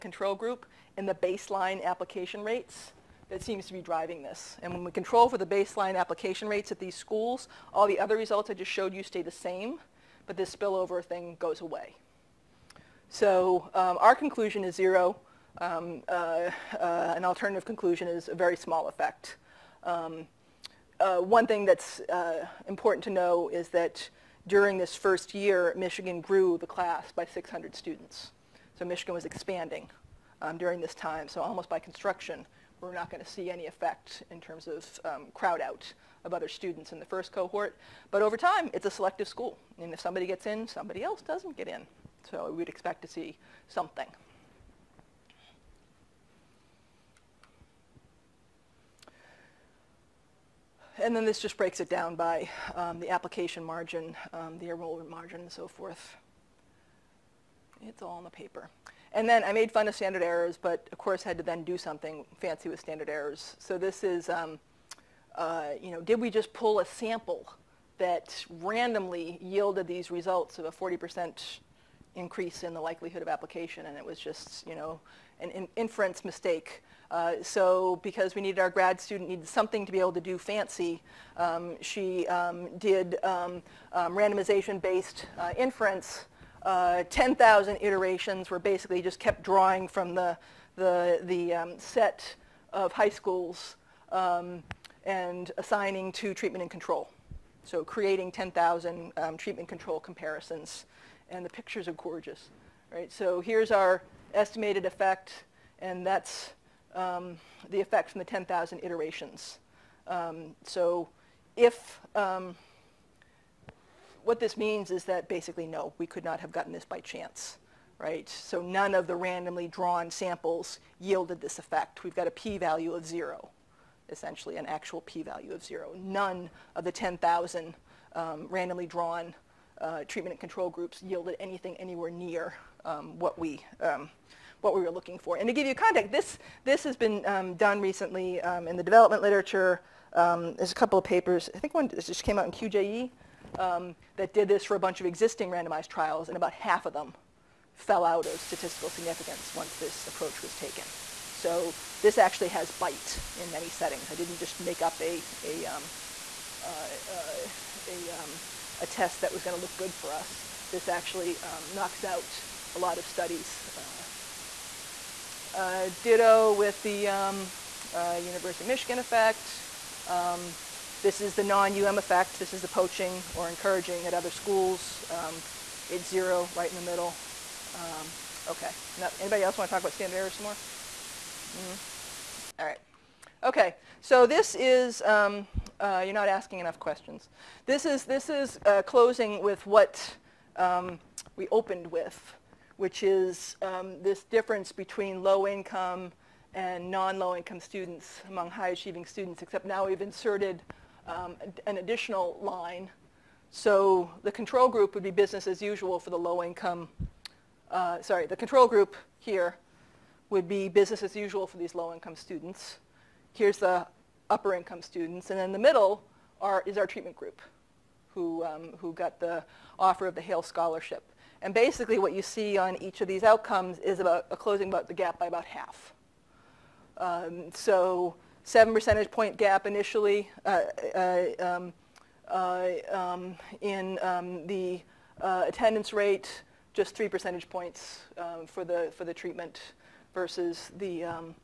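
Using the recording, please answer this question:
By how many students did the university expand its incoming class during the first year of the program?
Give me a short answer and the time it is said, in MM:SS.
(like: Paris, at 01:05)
600, at 00:27.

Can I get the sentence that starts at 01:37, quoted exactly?
So creating 10,000 um, treatment control comparisons.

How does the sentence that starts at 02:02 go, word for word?
We've got a p-value of zero, essentially an actual p-value of zero.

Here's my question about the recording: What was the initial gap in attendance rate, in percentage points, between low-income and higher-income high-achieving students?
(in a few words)
7.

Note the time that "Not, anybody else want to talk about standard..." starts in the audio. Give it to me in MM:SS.
02:58.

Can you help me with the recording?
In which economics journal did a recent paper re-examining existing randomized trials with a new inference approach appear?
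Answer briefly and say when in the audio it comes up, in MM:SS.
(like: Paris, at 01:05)
QJE, at 02:22.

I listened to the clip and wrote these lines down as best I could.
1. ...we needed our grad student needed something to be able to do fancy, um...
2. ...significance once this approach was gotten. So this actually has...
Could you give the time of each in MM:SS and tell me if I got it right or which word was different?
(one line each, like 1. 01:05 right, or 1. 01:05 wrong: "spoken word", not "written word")
1. 01:18 right
2. 02:28 wrong: "taken", not "gotten".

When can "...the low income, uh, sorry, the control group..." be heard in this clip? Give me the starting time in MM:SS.
03:26.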